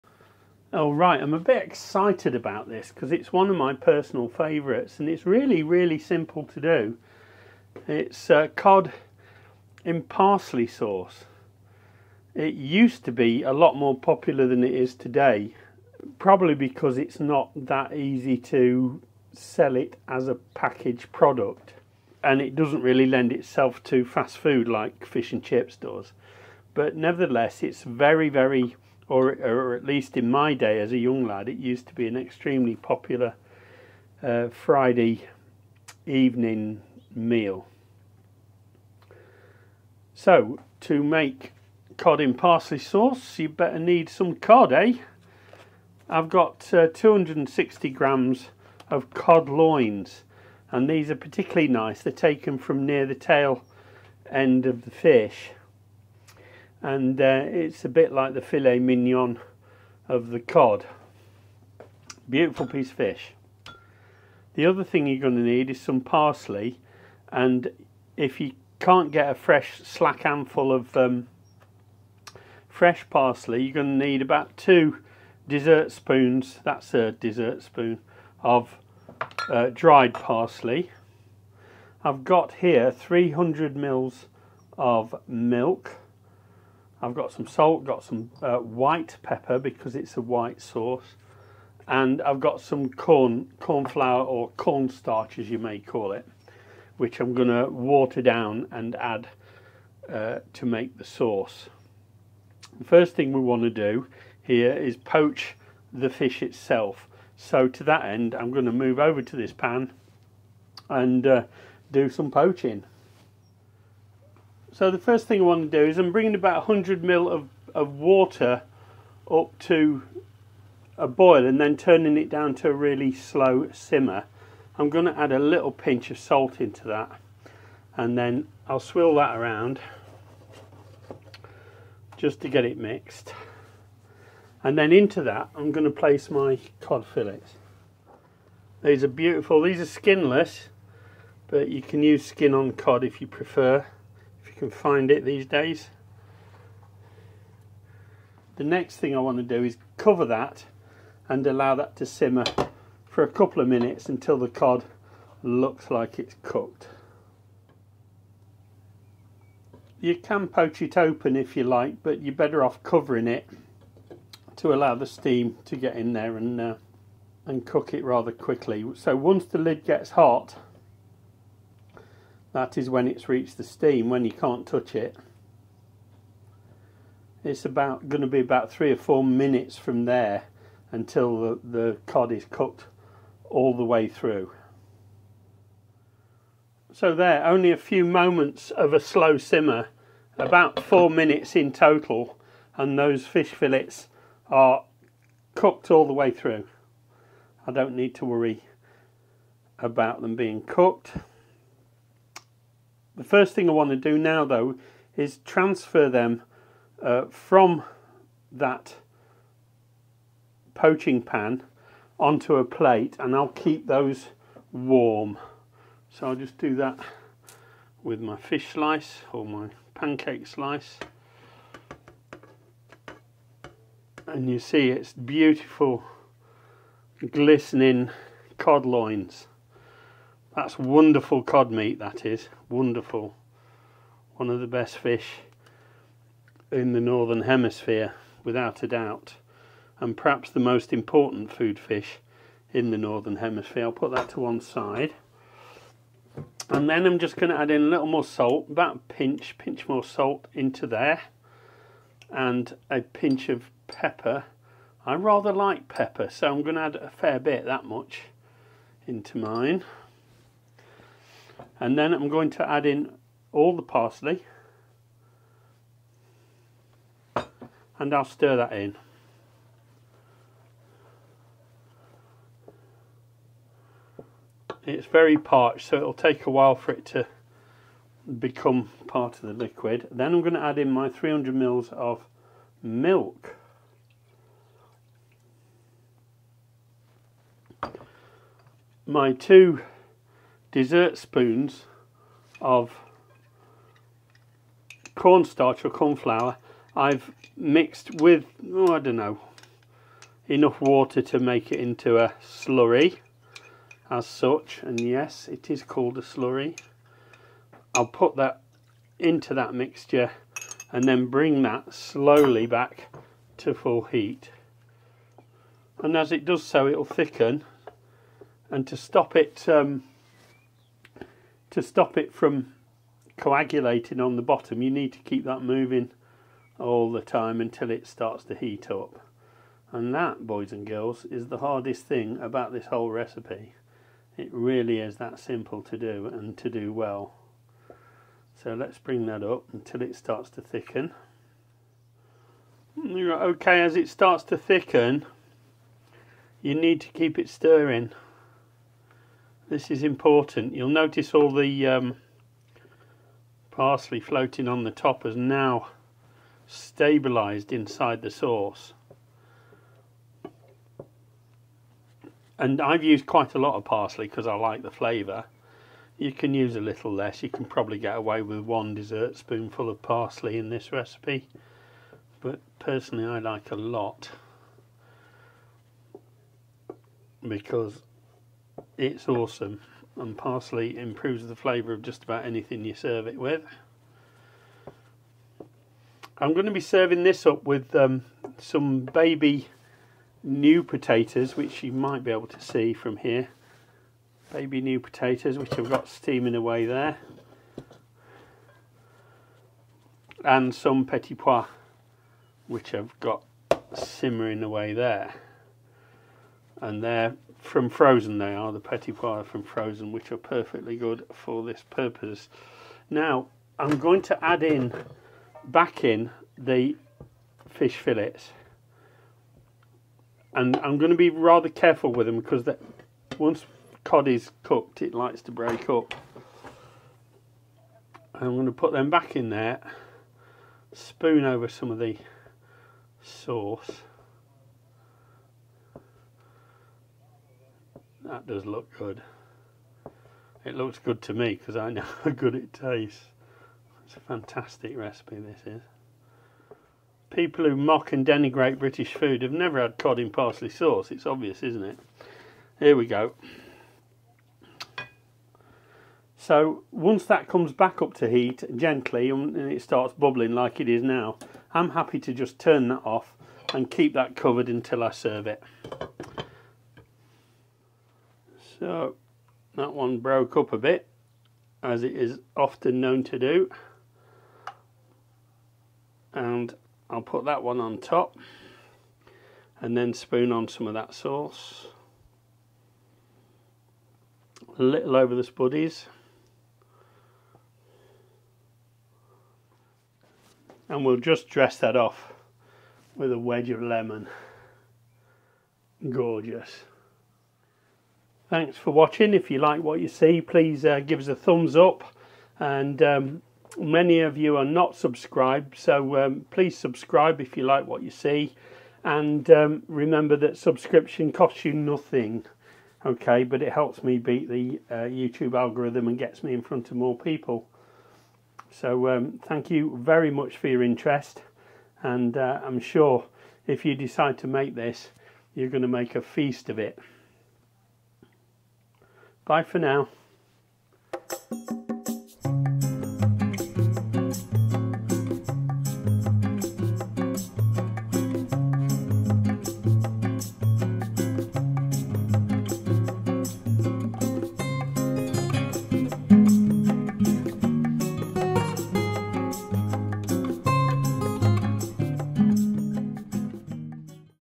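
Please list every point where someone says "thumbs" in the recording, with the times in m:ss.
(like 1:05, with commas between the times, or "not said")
8:21.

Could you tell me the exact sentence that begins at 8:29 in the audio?
And um, remember that subscription costs you nothing, okay?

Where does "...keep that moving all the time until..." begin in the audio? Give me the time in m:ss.
5:25.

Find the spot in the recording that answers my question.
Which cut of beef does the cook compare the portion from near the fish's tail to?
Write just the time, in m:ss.
0:58.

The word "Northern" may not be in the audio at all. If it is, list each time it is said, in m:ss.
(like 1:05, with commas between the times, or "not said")
3:56, 4:02.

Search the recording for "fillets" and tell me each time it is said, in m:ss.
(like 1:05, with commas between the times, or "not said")
2:17, 3:13, 6:57.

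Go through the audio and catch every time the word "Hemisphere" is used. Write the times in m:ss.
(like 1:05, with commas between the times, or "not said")
3:57, 4:03.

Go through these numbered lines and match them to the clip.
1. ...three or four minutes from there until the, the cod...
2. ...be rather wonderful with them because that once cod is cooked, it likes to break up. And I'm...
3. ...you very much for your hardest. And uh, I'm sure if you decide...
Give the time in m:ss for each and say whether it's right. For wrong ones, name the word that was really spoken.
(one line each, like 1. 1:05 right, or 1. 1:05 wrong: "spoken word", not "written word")
1. 2:58 right
2. 7:01 wrong: "careful", not "wonderful"
3. 8:39 wrong: "interest", not "hardest".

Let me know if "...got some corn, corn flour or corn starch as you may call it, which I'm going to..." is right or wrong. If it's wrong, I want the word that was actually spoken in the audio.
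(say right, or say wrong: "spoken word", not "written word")
right.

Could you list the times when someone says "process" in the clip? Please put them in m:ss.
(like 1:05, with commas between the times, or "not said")
not said.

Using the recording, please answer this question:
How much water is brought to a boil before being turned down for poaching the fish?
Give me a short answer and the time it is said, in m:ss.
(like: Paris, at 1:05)
100 ml, at 1:56.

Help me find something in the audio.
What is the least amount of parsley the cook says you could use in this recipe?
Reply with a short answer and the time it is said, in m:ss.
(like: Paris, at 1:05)
one dessert spoonful, at 6:08.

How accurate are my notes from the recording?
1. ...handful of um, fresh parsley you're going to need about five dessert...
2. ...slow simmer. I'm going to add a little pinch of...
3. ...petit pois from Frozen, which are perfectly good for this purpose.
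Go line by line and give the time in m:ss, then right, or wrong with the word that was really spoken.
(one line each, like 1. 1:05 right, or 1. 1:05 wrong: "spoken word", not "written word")
1. 1:10 wrong: "two", not "five"
2. 2:03 right
3. 6:48 right.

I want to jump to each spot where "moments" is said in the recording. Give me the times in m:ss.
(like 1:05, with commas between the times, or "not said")
3:08.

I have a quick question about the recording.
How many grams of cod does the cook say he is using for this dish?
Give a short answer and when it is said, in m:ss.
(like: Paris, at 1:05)
260 grams, at 0:46.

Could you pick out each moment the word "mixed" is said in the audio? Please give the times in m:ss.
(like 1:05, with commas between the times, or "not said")
2:12, 4:57.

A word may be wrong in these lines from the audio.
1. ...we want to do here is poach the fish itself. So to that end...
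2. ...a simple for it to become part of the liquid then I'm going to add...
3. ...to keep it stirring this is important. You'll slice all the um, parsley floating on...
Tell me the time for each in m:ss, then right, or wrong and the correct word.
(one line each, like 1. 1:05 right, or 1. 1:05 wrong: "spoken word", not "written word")
1. 1:43 right
2. 4:36 wrong: "while", not "simple"
3. 5:47 wrong: "notice", not "slice".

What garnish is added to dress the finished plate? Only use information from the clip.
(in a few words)
wedge of lemon.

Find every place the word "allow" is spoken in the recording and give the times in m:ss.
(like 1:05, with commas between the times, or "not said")
2:31, 2:44.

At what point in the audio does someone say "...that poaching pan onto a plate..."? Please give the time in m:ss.
3:28.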